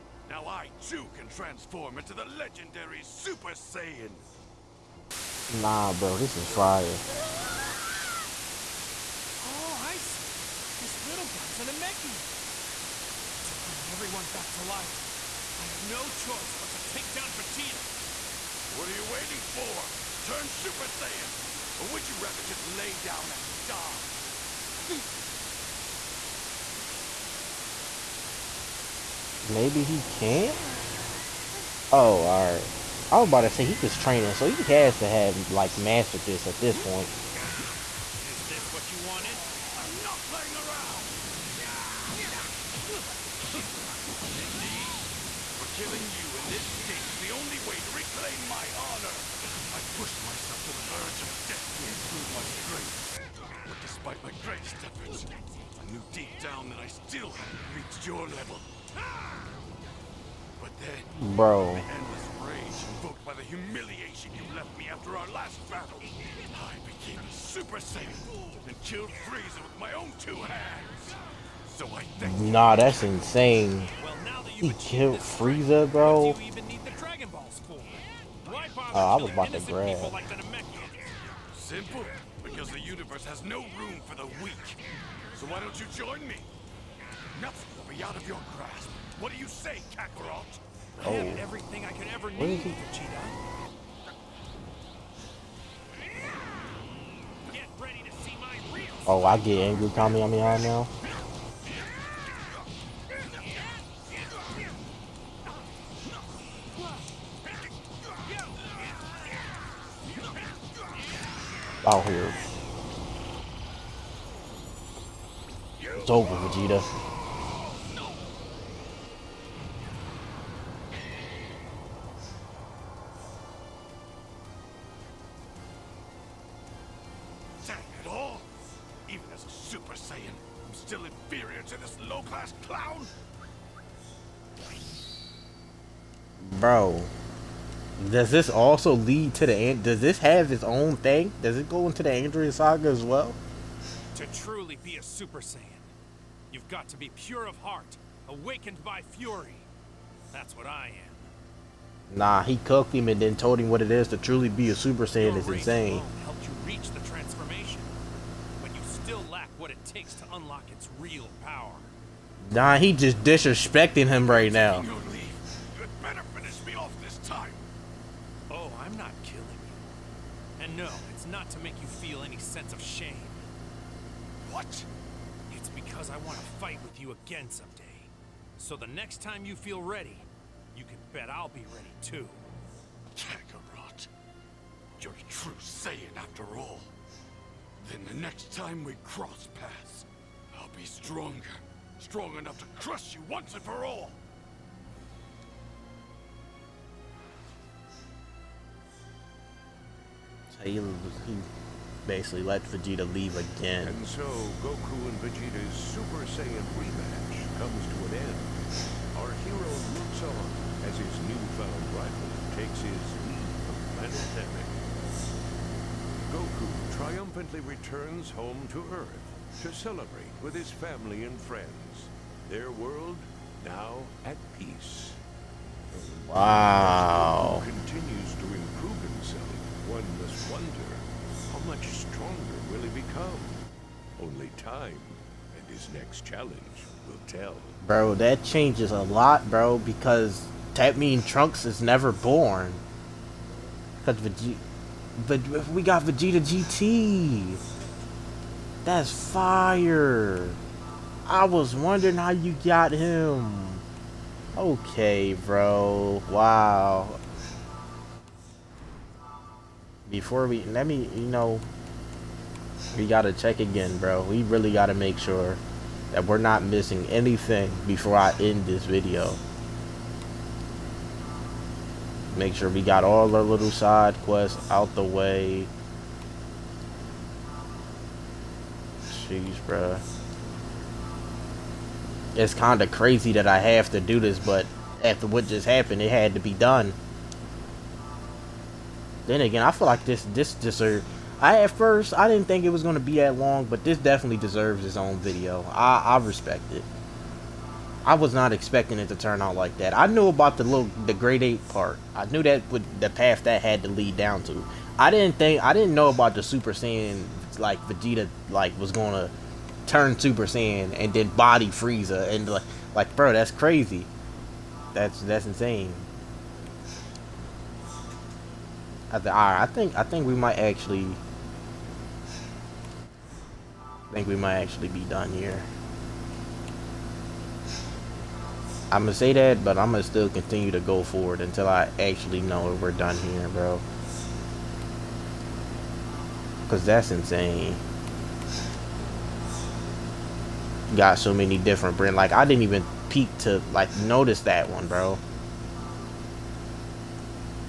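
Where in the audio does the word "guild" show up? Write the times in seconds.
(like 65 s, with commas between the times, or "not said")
not said.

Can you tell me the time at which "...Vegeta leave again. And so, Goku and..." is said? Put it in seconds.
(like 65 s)
202 s.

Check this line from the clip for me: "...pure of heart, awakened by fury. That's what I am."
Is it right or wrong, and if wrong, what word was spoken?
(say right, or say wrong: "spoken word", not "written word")
right.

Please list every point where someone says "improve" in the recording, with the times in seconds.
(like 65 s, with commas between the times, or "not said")
51 s, 228 s.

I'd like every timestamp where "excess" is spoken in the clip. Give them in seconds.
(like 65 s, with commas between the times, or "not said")
not said.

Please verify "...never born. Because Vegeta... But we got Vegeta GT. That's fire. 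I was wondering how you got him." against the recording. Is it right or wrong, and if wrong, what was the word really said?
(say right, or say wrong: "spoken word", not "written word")
right.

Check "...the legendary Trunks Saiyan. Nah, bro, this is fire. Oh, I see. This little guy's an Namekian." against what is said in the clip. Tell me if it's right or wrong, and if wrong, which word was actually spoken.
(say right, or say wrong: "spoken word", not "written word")
wrong: "Super", not "Trunks".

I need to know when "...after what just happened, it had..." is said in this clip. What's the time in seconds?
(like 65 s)
285 s.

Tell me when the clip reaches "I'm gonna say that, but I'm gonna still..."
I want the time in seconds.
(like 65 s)
328 s.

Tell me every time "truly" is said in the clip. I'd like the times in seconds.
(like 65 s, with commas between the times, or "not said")
144 s, 154 s.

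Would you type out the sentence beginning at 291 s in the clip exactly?
I at first I didn't think it was gonna be that long, but this definitely deserves its own video.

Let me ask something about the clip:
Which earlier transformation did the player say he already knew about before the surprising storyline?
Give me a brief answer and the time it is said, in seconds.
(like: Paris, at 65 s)
Great Ape, at 301 s.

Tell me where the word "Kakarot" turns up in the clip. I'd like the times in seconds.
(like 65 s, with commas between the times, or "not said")
89 s, 183 s.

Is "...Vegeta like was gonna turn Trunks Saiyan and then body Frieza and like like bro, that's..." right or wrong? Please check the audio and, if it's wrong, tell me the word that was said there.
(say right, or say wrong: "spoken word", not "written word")
wrong: "Super", not "Trunks".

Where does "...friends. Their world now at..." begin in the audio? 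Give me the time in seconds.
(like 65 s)
221 s.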